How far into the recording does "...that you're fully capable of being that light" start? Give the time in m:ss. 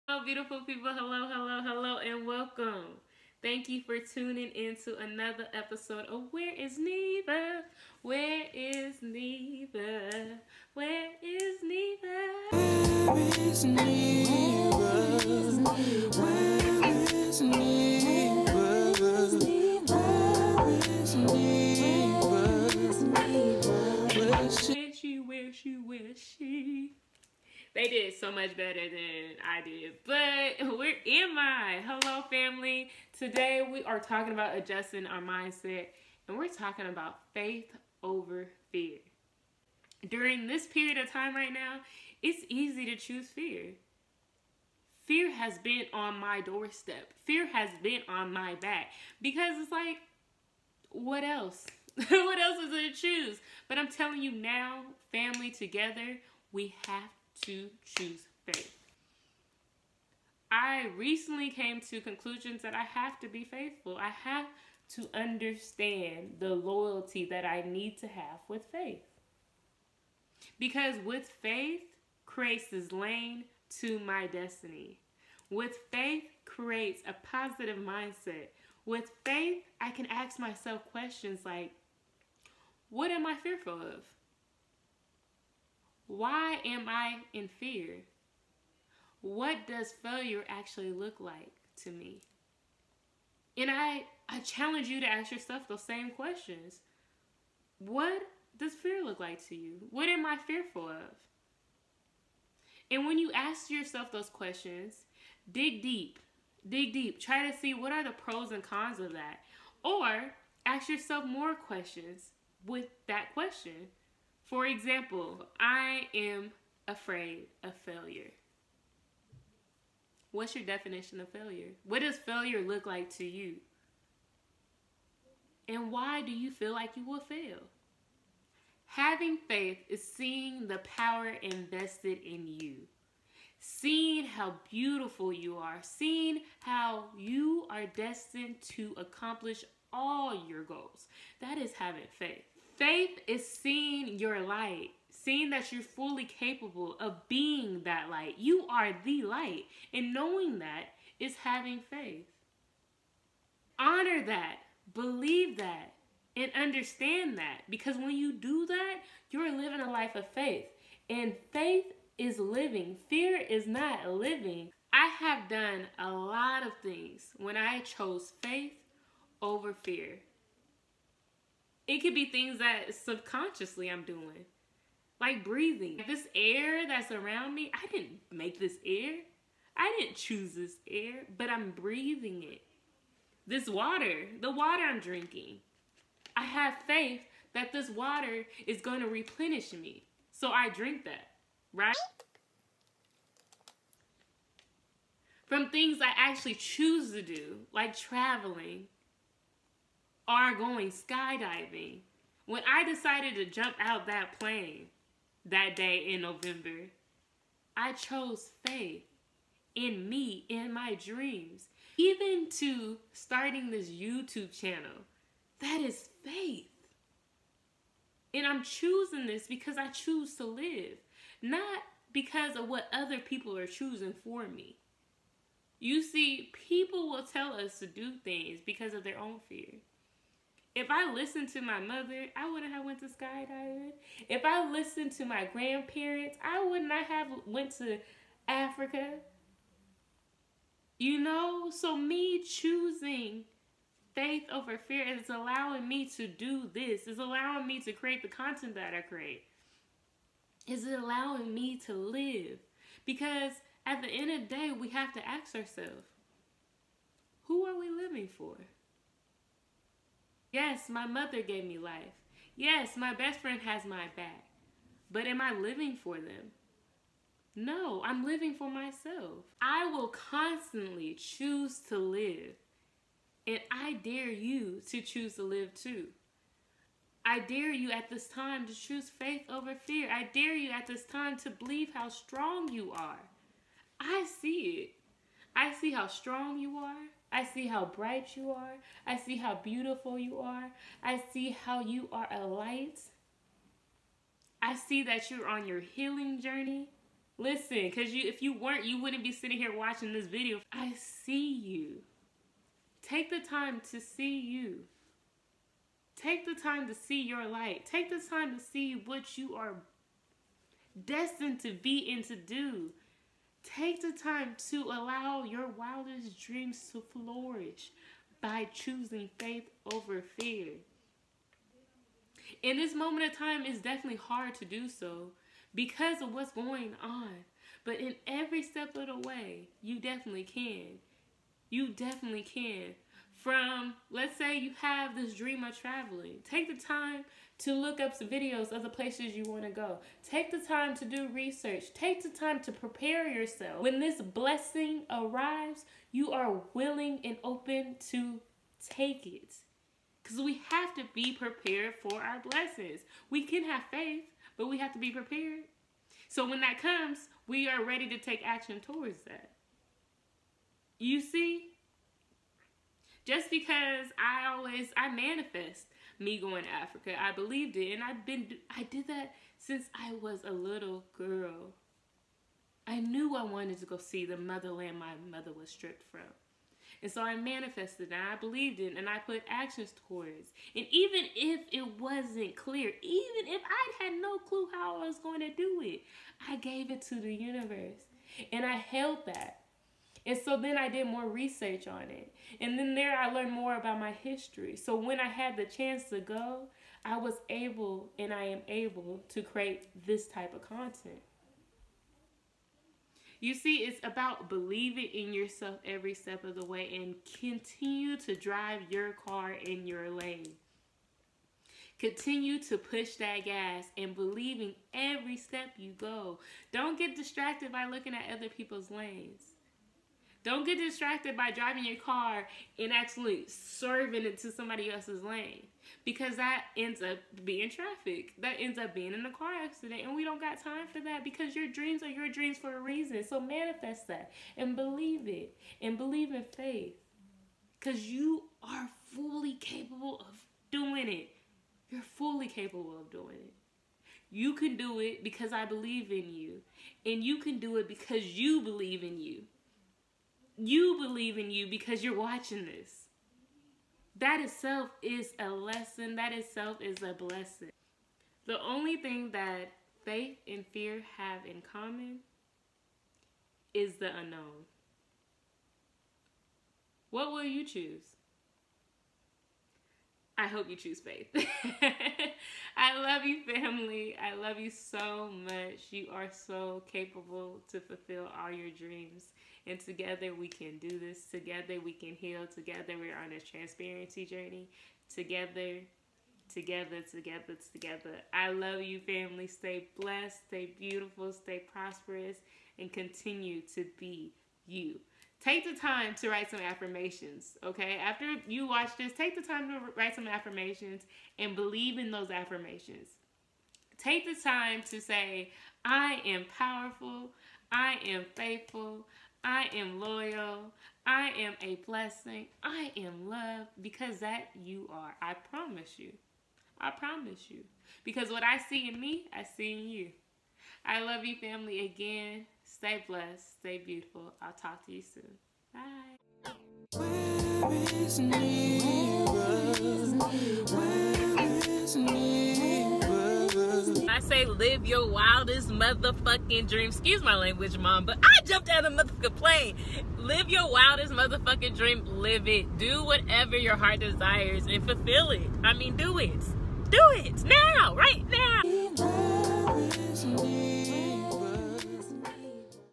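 2:25.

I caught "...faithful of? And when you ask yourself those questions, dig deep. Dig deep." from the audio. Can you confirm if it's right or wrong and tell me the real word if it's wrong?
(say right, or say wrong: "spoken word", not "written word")
wrong: "fearful", not "faithful".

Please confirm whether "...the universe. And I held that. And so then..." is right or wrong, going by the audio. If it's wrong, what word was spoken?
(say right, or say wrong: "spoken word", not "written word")
right.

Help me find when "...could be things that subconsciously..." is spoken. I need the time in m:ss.
2:52.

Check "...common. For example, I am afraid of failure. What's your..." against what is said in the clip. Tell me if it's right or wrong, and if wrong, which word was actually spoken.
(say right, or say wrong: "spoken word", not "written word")
wrong: "question", not "common".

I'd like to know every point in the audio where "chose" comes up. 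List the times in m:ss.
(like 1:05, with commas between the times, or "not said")
2:47, 3:27.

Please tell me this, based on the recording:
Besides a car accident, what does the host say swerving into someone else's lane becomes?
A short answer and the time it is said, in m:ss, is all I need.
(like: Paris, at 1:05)
Traffic, at 7:07.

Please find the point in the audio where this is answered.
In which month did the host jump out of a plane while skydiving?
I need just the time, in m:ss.
3:26.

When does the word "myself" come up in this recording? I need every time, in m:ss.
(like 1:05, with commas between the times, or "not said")
1:20, 4:28.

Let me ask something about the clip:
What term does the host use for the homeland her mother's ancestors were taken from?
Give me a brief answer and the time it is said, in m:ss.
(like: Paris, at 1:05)
The motherland, at 6:14.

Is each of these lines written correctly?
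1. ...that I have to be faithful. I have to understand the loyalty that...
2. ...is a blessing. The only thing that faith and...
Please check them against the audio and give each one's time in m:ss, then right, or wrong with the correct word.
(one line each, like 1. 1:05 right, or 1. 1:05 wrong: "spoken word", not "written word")
1. 1:02 right
2. 7:36 right.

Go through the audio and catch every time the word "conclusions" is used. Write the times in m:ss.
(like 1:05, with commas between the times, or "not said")
1:02.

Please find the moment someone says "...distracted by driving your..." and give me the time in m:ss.
7:00.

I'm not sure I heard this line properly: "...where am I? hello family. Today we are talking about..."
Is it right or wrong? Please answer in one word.
right.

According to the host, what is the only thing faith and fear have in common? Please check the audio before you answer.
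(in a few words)
The unknown.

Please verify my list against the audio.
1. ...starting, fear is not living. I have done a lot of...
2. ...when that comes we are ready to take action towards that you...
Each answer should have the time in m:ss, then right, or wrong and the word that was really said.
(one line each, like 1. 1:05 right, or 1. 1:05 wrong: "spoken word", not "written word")
1. 2:42 wrong: "living", not "starting"
2. 5:56 right.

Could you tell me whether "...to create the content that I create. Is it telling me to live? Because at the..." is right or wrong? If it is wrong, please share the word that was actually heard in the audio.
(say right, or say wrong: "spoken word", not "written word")
wrong: "allowing", not "telling".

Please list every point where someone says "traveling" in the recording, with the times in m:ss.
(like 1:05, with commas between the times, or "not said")
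3:17, 5:35.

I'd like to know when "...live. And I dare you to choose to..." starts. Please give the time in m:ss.
4:31.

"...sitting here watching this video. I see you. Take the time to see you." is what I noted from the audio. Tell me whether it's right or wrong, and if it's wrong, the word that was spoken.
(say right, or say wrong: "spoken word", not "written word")
right.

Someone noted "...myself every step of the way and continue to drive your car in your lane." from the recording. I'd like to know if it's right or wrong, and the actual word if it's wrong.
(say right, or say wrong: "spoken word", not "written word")
wrong: "yourself", not "myself".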